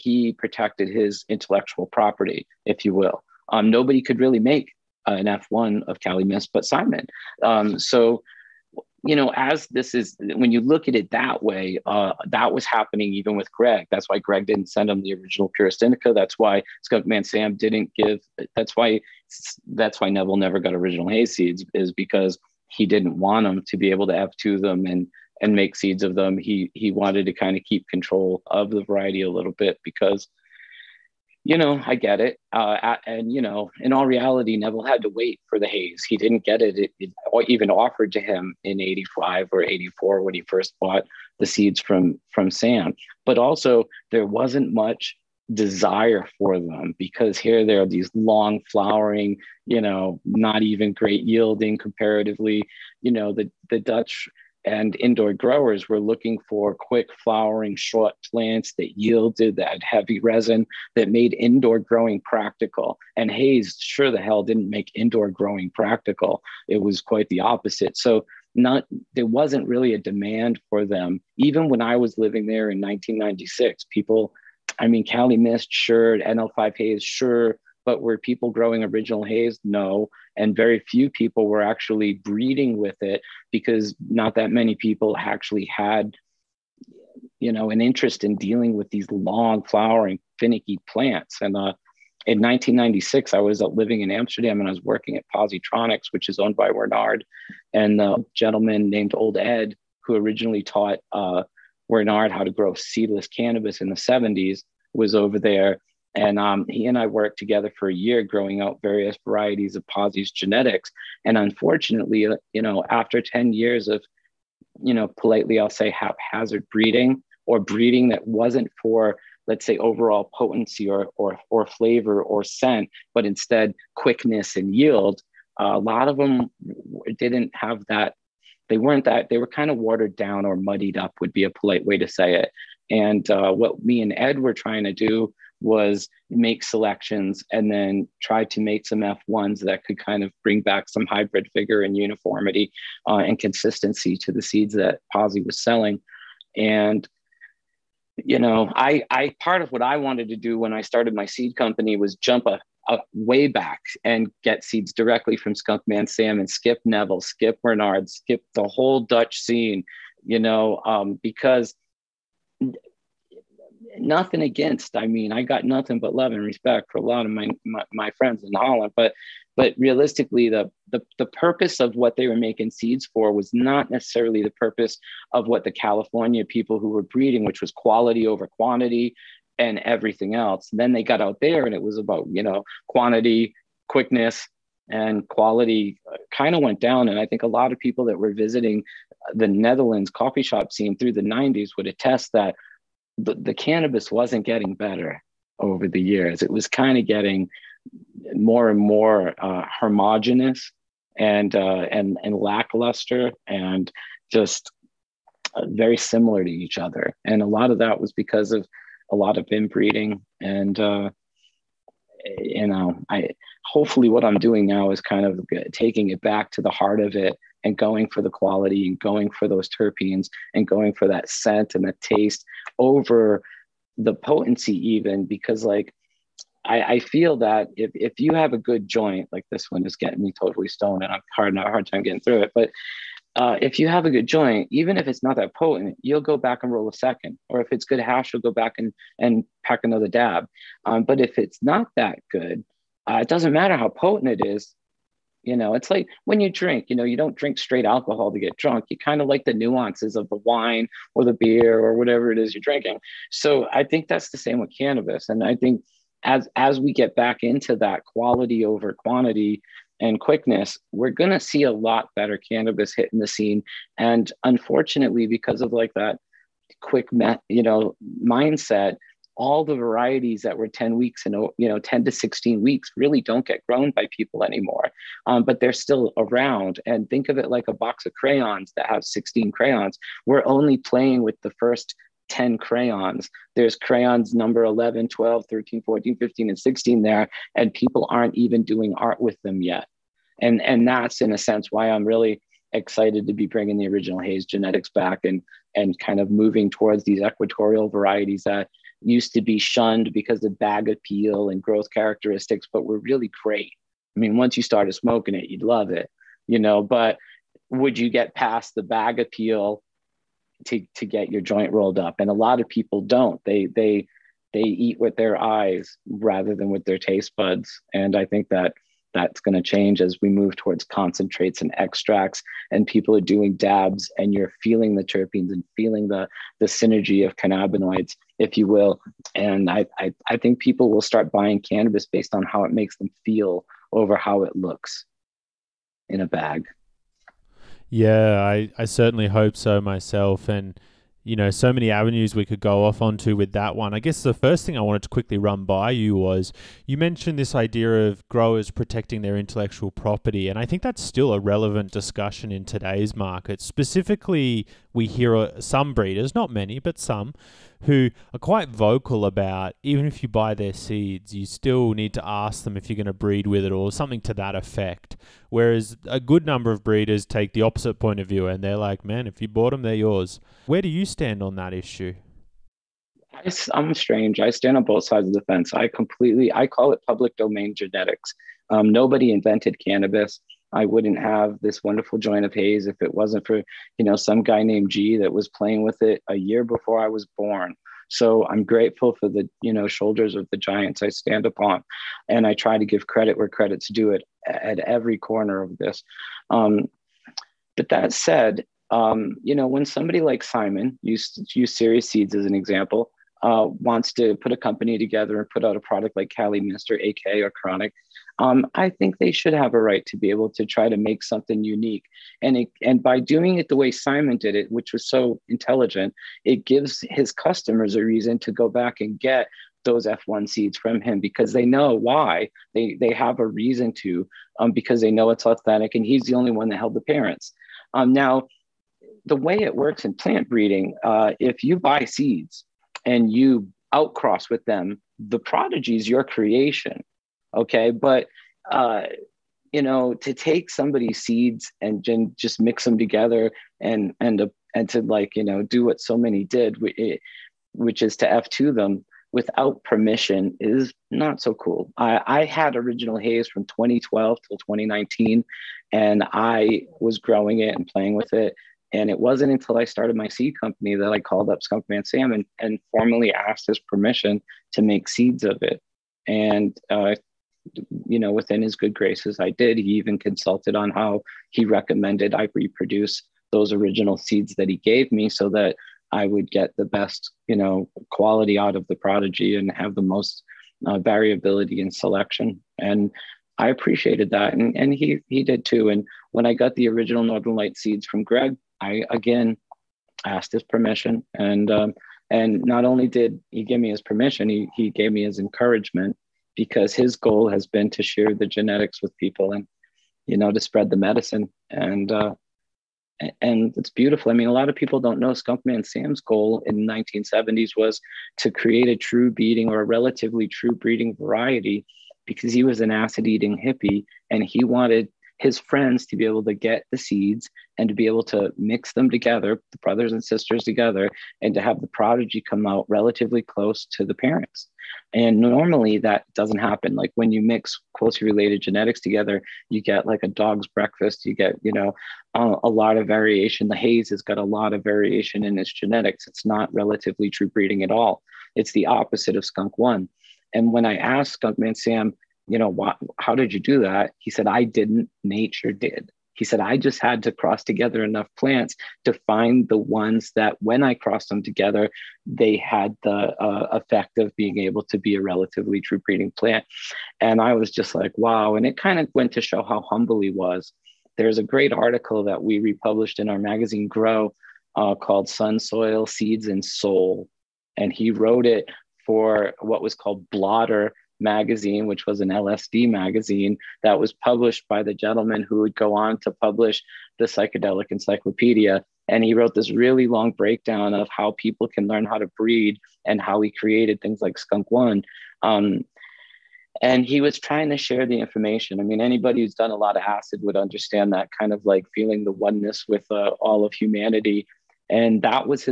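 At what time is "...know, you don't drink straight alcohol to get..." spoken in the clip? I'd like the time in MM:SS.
04:06.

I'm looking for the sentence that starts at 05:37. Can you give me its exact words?
Yeah, I, I certainly hope so myself.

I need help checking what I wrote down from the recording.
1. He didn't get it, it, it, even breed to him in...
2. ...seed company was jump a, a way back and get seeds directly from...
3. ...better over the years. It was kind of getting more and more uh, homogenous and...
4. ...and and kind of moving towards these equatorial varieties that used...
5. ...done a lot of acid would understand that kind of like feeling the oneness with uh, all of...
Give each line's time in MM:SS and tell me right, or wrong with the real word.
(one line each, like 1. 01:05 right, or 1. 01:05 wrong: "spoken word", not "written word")
1. 00:36 wrong: "offered", not "breed"
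2. 02:31 right
3. 03:14 right
4. 04:55 right
5. 09:49 right.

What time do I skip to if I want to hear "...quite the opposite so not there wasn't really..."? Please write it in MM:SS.
01:07.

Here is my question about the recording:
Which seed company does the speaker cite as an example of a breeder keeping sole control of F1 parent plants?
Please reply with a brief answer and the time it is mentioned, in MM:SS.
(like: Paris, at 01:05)
Serious Seeds, at 06:41.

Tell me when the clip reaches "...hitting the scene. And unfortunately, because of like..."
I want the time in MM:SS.
04:22.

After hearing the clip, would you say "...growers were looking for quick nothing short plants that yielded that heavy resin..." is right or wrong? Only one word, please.
wrong.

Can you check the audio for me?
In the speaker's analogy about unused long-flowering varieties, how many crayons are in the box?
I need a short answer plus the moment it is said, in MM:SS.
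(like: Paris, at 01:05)
16, at 04:39.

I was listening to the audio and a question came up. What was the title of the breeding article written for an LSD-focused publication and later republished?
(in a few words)
Sun, Soil, Seeds, and Soul.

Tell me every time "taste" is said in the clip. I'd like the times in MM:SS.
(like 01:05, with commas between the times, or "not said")
03:42, 05:16.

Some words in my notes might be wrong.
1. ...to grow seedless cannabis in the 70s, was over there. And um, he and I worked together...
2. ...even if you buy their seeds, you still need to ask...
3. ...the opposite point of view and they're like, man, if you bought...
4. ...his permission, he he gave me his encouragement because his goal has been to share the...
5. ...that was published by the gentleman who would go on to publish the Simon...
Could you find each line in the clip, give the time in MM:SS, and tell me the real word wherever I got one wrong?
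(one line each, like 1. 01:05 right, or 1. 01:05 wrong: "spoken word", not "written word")
1. 01:42 right
2. 05:59 right
3. 06:07 right
4. 08:13 right
5. 09:33 wrong: "Psychedelic", not "Simon".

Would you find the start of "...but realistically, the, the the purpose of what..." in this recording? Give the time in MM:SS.
02:49.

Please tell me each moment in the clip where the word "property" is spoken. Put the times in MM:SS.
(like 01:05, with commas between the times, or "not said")
00:01, 05:49.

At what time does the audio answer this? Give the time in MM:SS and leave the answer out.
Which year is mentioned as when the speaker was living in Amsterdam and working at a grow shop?
01:32.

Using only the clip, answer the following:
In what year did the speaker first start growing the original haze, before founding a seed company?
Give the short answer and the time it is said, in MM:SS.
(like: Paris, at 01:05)
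2012, at 07:33.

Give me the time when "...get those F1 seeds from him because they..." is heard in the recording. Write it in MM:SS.
06:59.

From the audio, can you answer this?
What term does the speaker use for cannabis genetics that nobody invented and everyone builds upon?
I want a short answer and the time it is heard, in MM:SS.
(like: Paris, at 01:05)
public domain genetics, at 06:17.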